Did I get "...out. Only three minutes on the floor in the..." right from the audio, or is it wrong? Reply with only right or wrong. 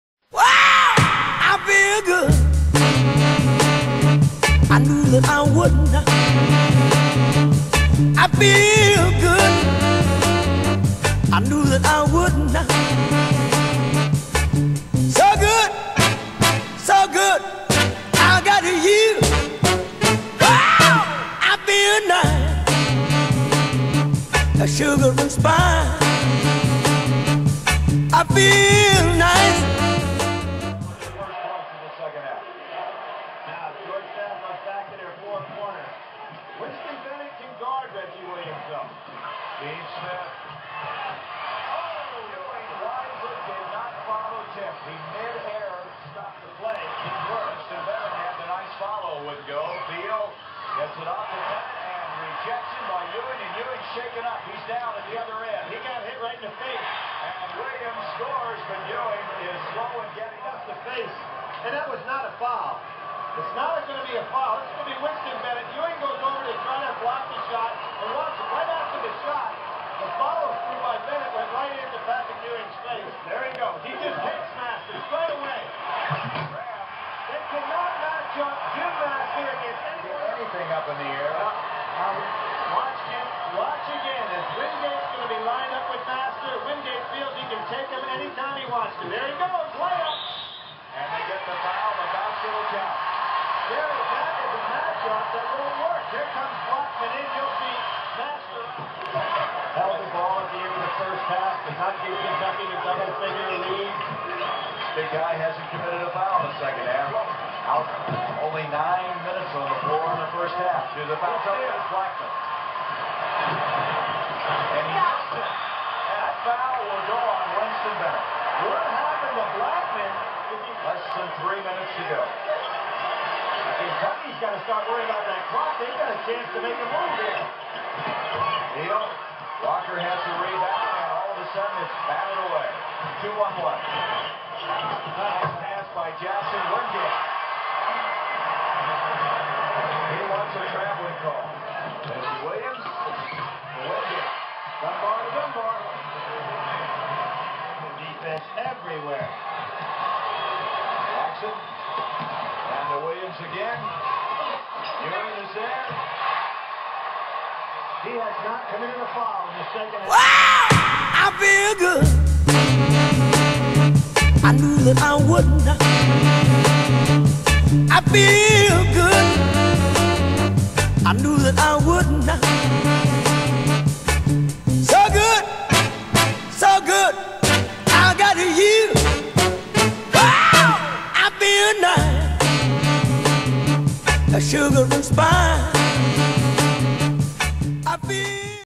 wrong.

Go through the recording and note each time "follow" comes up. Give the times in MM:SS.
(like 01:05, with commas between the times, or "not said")
00:44, 00:48.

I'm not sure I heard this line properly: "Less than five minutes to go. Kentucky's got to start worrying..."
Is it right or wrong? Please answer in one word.
wrong.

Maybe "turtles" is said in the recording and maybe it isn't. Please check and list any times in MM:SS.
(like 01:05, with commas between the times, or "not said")
not said.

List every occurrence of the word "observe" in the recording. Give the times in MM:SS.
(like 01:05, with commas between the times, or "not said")
not said.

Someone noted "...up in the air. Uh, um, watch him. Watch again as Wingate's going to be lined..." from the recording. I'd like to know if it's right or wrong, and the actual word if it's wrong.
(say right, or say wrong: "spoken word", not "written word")
right.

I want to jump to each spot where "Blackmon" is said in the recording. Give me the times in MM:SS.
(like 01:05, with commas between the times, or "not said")
01:36, 01:51, 01:59.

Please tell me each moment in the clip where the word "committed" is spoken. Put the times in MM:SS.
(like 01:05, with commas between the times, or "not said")
01:45, 02:38.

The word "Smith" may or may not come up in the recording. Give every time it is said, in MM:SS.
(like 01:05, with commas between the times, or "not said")
00:39.